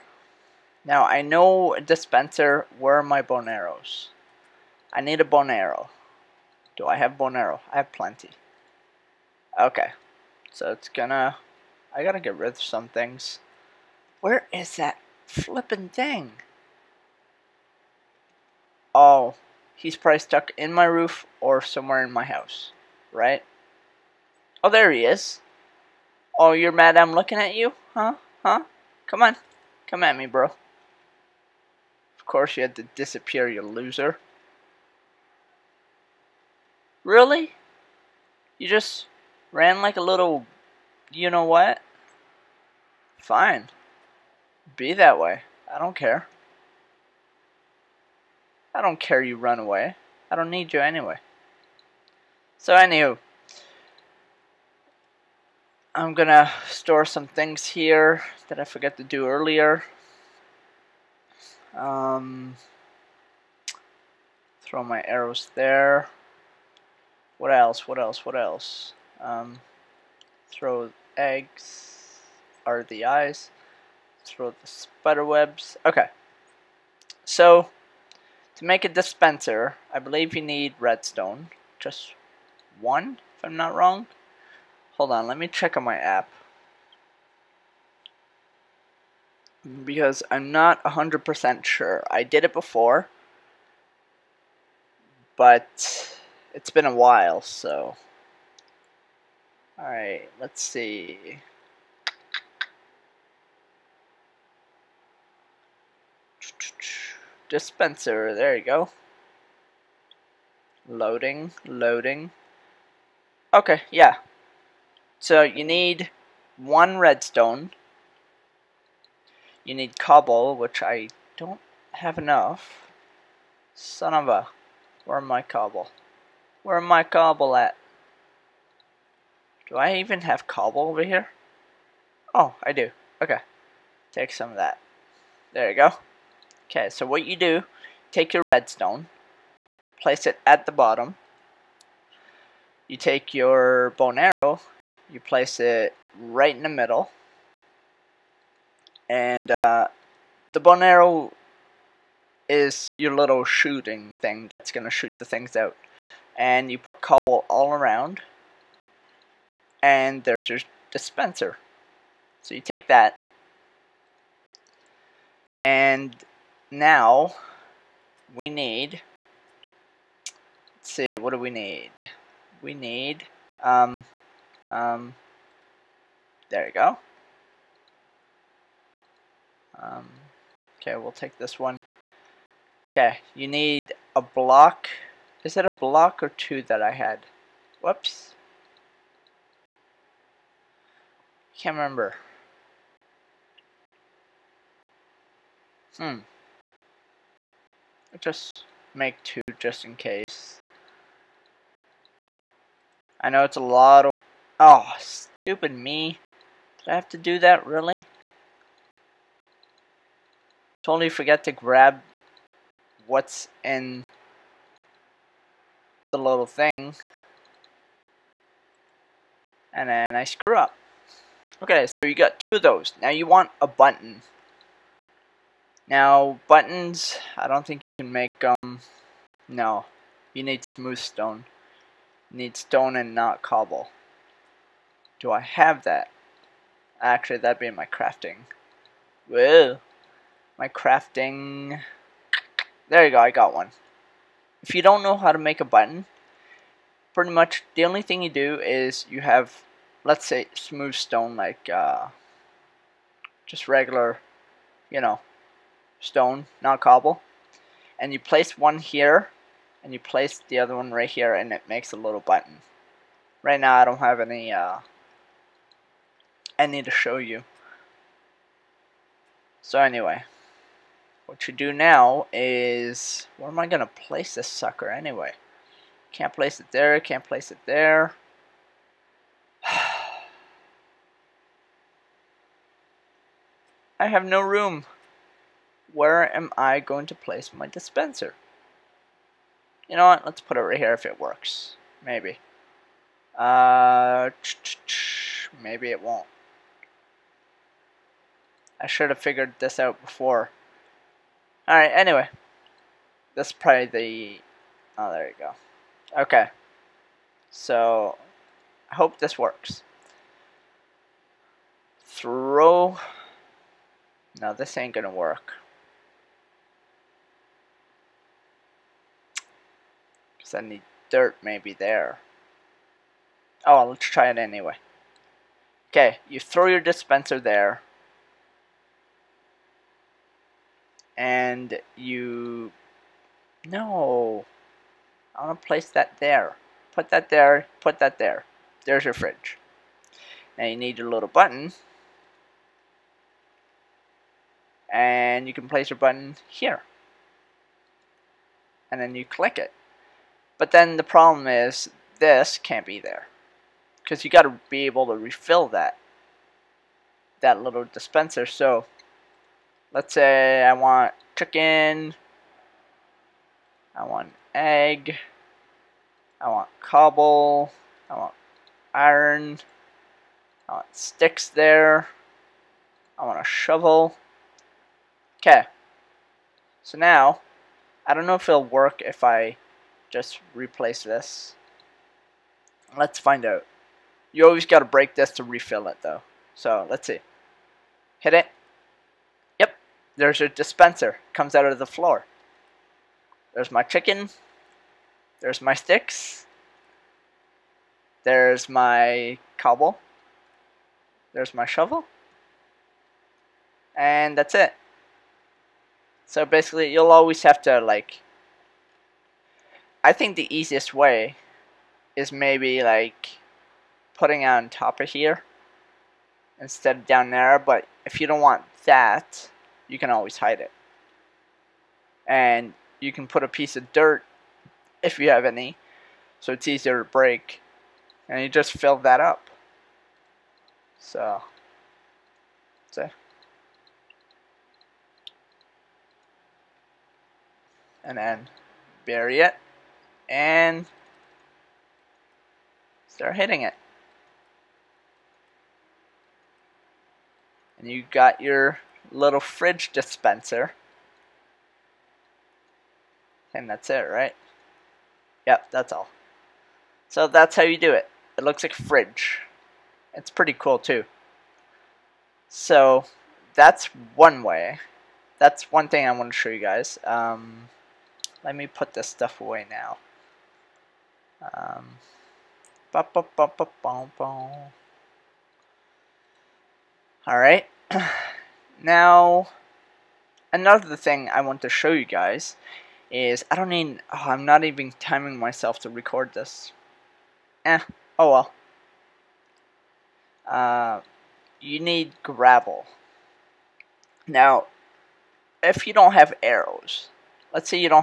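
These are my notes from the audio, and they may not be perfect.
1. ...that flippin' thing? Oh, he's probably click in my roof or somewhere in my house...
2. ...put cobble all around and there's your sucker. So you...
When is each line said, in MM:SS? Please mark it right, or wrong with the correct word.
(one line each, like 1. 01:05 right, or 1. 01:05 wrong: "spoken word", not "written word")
1. 00:14 wrong: "stuck", not "click"
2. 02:36 wrong: "dispenser", not "sucker".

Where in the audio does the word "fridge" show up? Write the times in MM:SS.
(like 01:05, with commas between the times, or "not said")
05:39, 07:29, 07:38.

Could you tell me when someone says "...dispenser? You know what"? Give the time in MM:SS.
04:47.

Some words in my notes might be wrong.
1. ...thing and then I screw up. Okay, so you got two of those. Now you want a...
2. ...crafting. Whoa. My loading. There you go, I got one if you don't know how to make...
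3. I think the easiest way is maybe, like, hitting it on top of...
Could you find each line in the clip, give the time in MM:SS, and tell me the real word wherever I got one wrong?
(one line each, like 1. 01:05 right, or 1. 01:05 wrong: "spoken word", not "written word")
1. 03:36 right
2. 03:57 wrong: "crafting", not "loading"
3. 06:50 wrong: "putting", not "hitting".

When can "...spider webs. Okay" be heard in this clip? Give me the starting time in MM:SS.
01:14.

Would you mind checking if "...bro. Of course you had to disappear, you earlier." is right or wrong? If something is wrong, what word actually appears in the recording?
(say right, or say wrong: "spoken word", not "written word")
wrong: "loser", not "earlier".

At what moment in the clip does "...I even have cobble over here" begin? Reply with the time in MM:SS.
02:09.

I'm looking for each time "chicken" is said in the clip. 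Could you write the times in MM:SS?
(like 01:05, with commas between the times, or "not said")
06:01, 06:33.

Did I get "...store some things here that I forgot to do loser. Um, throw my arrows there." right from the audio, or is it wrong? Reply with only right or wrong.
wrong.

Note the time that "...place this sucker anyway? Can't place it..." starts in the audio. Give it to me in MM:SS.
04:33.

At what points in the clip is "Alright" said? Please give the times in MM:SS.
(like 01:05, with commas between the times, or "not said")
01:39, 05:01.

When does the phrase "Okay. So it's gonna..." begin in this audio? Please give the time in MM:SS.
00:09.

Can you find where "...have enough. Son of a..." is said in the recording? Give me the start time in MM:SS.
02:01.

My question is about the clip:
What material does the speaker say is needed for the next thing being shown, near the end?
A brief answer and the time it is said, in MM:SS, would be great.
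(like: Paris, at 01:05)
gravel, at 08:11.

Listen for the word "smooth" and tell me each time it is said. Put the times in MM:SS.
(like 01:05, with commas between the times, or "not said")
03:50, 04:10.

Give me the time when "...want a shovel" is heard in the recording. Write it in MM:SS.
06:13.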